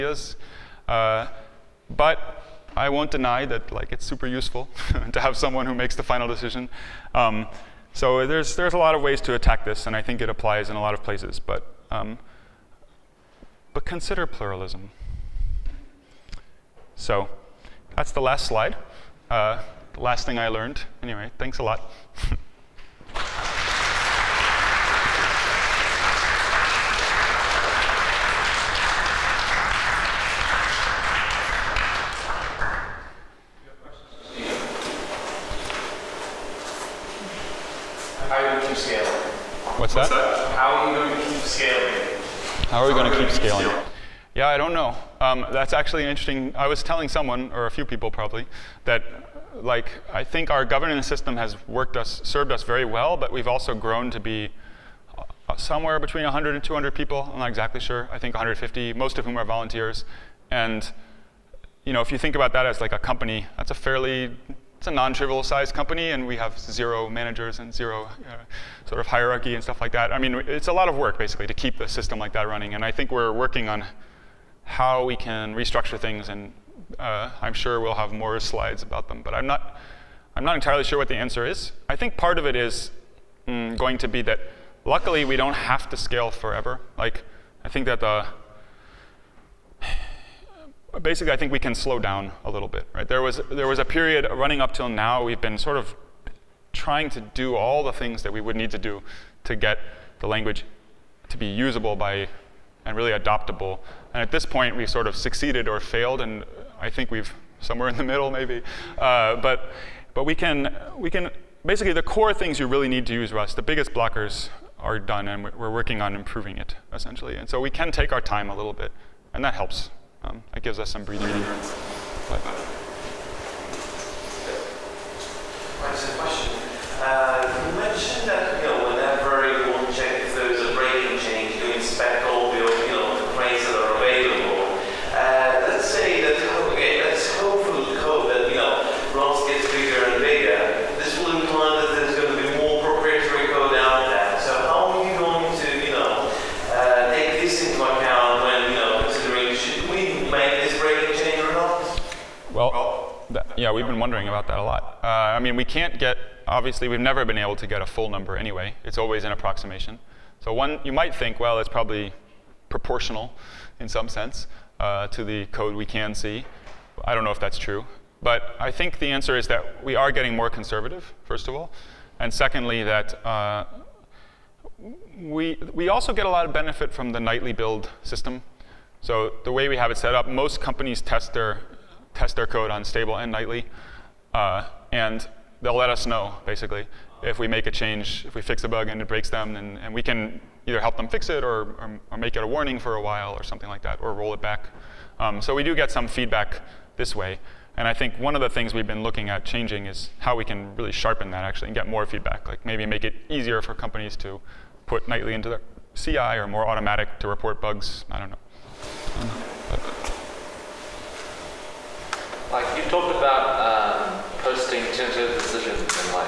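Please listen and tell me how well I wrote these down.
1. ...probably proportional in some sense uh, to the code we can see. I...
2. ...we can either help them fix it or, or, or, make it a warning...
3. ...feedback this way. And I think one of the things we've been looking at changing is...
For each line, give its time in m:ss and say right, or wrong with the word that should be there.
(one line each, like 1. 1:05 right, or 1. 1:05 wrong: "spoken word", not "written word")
1. 2:41 right
2. 3:09 right
3. 3:16 right.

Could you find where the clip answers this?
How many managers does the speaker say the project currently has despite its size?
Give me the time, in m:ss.
1:06.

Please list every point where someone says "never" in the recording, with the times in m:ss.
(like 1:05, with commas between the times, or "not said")
2:36.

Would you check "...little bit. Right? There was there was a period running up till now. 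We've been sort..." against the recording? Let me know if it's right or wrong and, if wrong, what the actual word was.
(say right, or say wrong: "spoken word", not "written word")
right.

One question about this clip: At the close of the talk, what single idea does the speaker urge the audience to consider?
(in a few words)
Pluralism.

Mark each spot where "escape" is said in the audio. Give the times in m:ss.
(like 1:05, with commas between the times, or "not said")
not said.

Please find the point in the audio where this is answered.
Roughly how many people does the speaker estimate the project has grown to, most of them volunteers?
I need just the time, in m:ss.
0:58.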